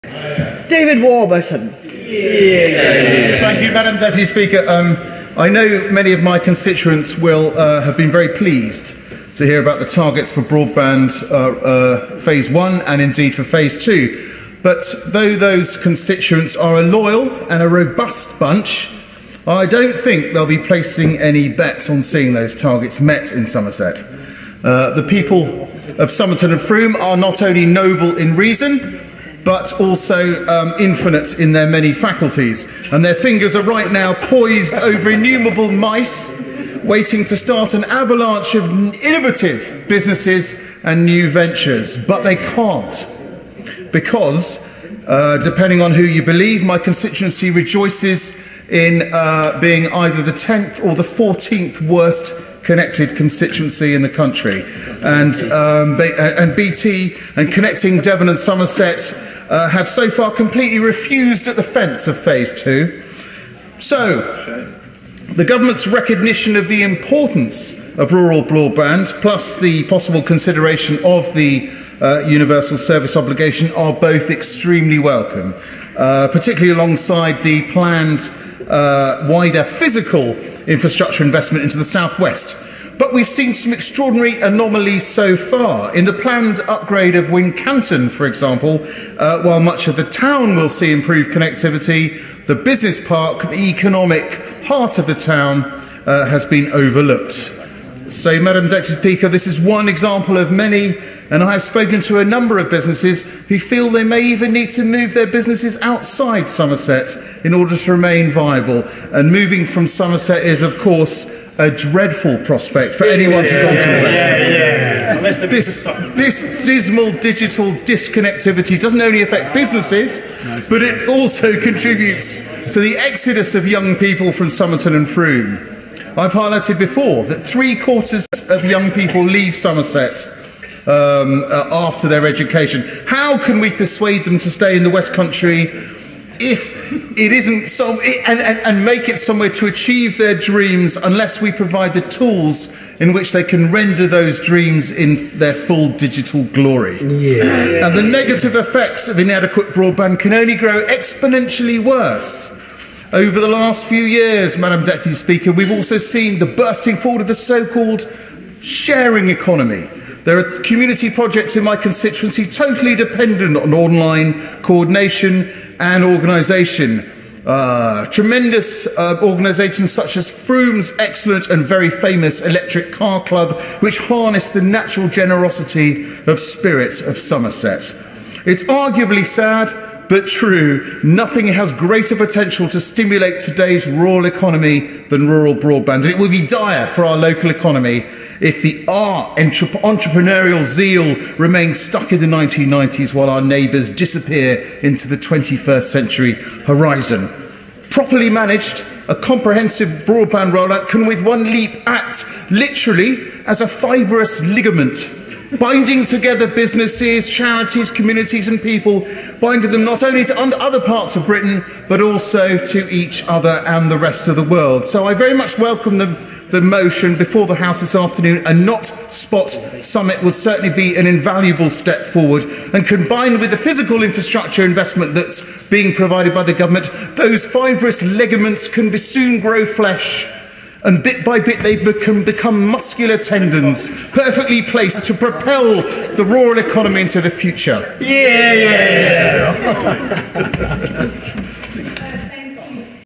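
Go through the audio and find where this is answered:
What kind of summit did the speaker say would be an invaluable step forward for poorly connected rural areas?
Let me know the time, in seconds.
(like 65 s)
218 s.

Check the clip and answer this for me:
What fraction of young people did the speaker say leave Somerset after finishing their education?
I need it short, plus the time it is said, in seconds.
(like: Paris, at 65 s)
three quarters, at 127 s.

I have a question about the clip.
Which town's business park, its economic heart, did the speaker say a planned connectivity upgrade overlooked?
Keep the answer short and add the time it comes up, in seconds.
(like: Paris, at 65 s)
Wincanton, at 87 s.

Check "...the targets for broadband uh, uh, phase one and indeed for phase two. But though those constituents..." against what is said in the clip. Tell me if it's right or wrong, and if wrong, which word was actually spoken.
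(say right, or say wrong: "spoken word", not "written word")
right.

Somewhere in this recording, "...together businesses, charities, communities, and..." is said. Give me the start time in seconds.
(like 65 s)
206 s.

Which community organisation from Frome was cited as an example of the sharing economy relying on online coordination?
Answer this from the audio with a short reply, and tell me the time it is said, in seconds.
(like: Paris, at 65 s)
Electric Car Club, at 172 s.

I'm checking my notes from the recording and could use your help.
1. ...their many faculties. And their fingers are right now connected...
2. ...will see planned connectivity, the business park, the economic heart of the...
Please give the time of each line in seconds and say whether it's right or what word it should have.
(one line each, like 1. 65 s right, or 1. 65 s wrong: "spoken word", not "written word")
1. 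31 s wrong: "poised", not "connected"
2. 90 s wrong: "improved", not "planned".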